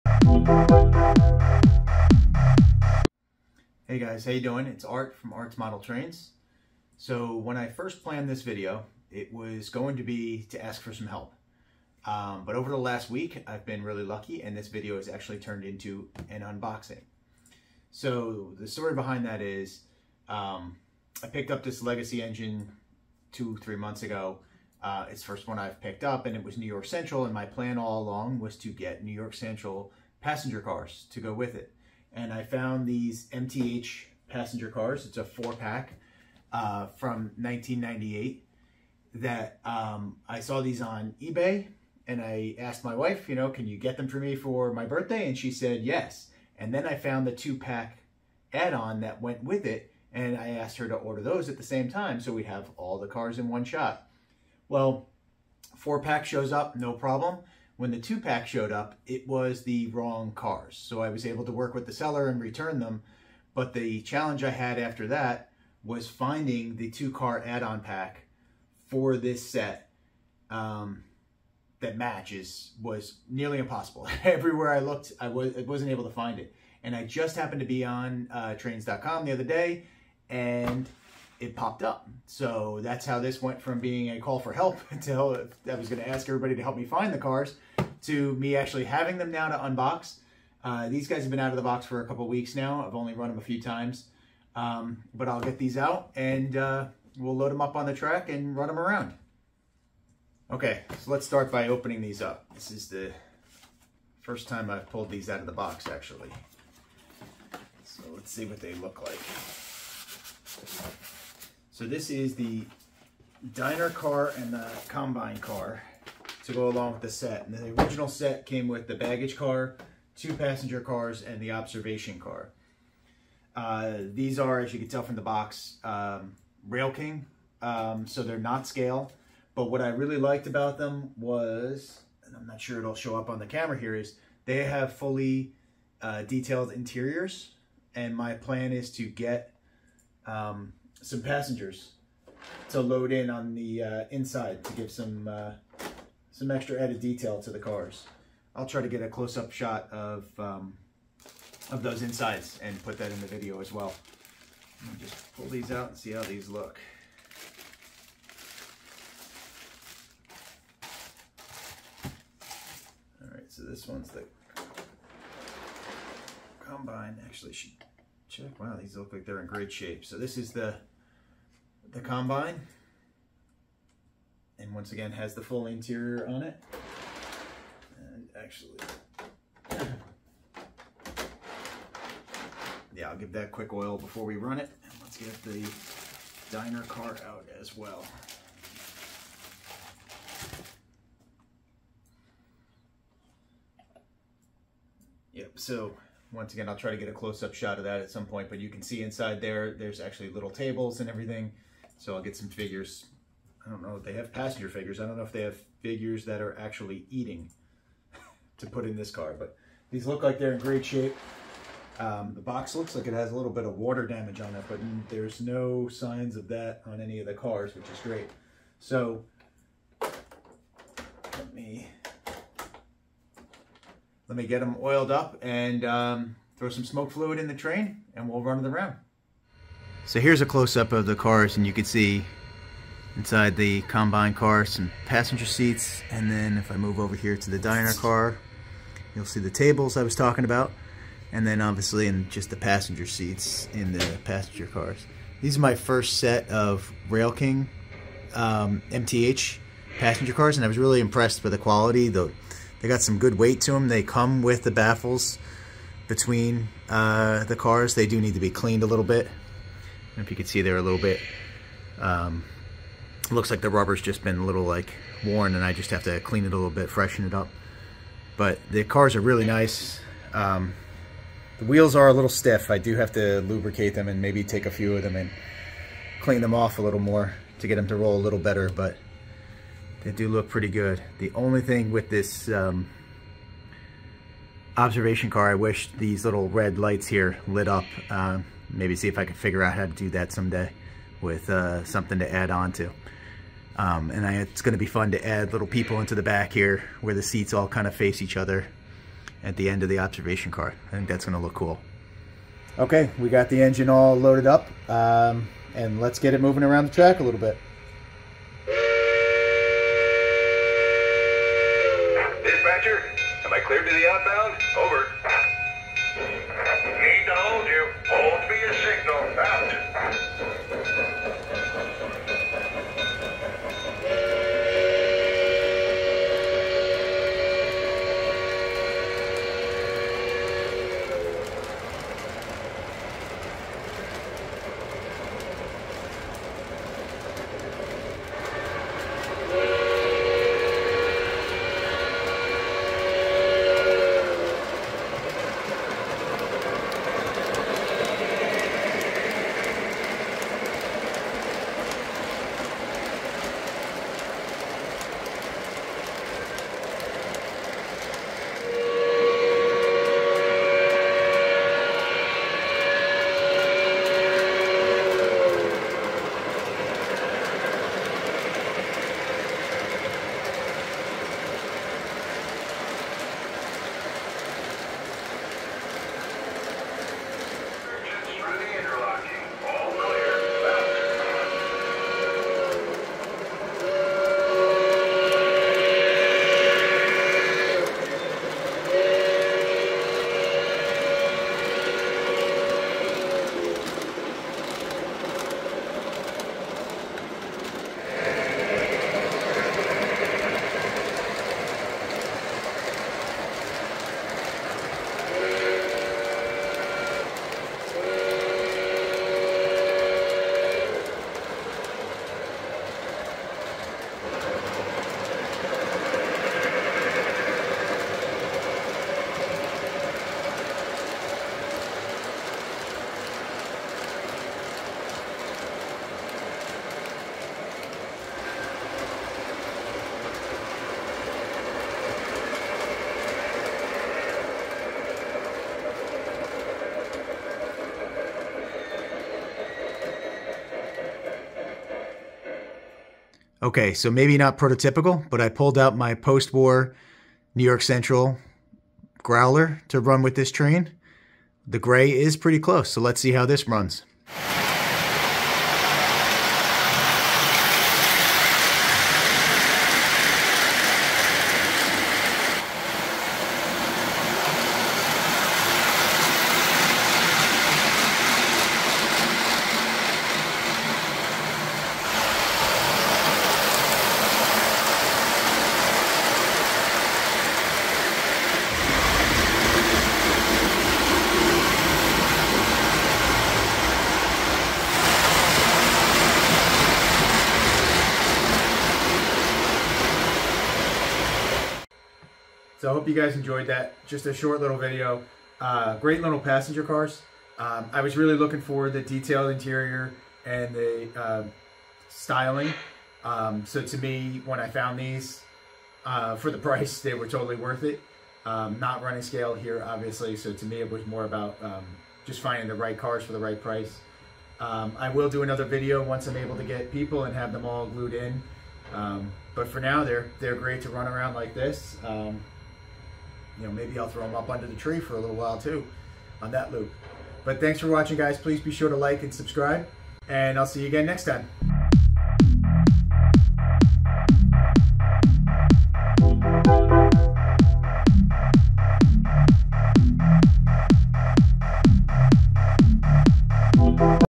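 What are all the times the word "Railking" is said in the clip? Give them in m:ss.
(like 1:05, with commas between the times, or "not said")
2:06, 4:07.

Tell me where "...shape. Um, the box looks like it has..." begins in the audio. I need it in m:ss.
3:30.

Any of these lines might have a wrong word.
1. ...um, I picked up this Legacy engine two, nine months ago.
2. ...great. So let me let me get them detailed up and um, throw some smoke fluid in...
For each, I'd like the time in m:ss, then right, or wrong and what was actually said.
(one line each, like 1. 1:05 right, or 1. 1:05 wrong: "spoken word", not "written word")
1. 0:20 wrong: "three", not "nine"
2. 3:38 wrong: "oiled", not "detailed".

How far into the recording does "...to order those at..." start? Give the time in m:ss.
0:50.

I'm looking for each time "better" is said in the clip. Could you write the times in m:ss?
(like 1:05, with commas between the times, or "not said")
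4:38.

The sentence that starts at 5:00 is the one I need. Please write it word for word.
I think that's going to look cool.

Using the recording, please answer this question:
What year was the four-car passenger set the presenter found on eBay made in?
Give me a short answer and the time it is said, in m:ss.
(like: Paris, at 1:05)
1998, at 0:37.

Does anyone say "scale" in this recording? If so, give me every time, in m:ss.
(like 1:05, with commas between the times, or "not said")
2:08, 8:29.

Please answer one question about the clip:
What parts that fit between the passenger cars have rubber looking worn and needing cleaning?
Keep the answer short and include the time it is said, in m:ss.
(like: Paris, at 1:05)
baffles, at 4:14.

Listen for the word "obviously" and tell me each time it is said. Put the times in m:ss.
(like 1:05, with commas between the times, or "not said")
4:01, 8:29.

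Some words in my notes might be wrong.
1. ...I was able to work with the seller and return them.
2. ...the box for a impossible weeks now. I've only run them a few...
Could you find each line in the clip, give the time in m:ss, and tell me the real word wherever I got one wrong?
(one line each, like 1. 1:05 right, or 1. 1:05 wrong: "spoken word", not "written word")
1. 1:01 right
2. 1:31 wrong: "couple", not "impossible".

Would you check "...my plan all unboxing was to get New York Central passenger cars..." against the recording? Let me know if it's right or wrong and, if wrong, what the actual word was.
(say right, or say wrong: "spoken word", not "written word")
wrong: "along", not "unboxing".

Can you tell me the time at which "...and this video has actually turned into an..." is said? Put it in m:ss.
0:14.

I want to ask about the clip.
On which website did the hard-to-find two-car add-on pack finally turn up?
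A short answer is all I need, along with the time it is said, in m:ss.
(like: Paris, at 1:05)
trains.com, at 1:18.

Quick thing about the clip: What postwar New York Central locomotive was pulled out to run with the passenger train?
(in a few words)
Growler.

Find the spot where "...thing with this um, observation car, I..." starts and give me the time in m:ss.
4:41.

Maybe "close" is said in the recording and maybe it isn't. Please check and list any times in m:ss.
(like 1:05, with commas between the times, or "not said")
2:29, 3:17, 3:50, 7:32.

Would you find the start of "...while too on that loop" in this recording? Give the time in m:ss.
8:45.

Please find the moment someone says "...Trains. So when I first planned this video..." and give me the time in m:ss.
0:05.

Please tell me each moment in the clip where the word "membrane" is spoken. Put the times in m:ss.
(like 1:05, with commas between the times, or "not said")
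not said.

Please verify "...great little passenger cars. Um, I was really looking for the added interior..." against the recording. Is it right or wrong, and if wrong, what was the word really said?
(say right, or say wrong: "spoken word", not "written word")
wrong: "detailed", not "added".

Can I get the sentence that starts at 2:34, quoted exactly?
just pull these out and see how these look.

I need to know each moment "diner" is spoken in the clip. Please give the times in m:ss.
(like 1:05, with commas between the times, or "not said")
1:53, 3:06, 3:57.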